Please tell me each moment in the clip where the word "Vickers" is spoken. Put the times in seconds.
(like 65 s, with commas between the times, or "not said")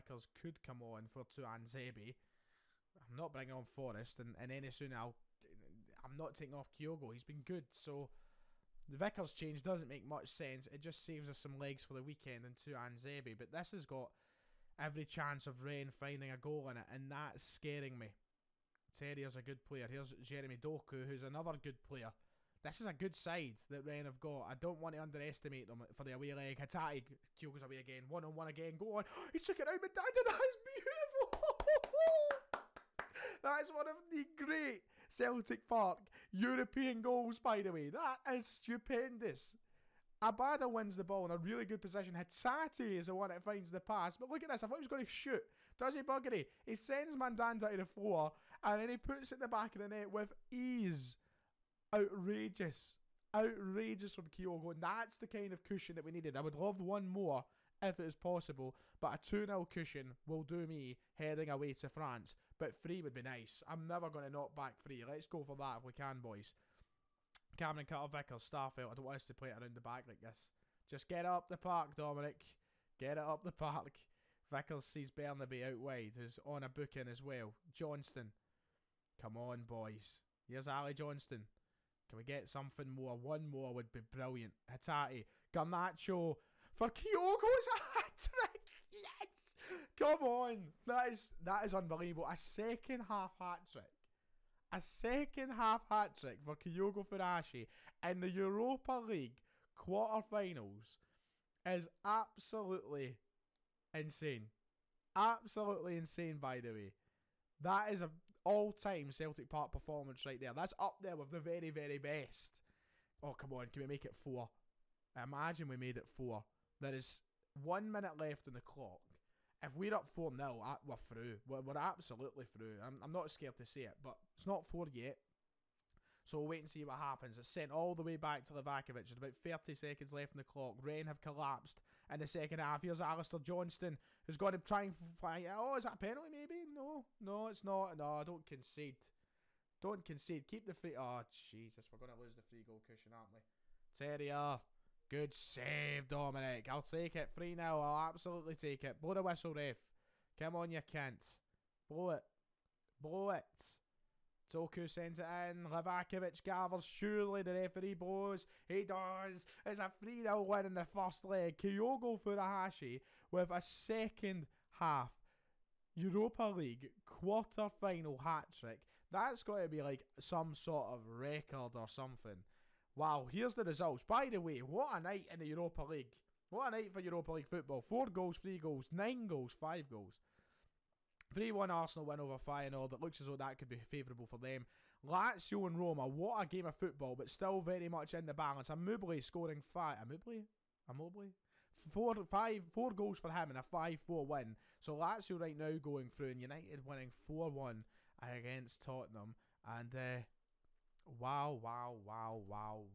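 8 s, 68 s, 74 s.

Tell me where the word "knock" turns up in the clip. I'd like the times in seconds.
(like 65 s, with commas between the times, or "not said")
64 s.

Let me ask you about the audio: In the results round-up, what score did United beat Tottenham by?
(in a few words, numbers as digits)
4-1.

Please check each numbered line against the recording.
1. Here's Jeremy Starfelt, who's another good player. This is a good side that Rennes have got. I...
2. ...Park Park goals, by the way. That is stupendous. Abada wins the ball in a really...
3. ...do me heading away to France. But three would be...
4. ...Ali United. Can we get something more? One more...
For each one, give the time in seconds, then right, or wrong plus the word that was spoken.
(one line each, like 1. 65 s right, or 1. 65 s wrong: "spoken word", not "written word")
1. 19 s wrong: "Doku", not "Starfelt"
2. 35 s wrong: "European", not "Park"
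3. 60 s right
4. 80 s wrong: "Johnston", not "United".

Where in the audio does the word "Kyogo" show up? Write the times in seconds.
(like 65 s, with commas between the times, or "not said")
6 s, 27 s, 54 s, 86 s, 96 s, 161 s.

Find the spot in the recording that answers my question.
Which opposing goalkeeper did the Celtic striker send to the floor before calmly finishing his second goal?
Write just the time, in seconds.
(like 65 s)
47 s.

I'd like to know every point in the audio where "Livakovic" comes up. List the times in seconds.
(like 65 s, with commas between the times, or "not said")
128 s, 155 s.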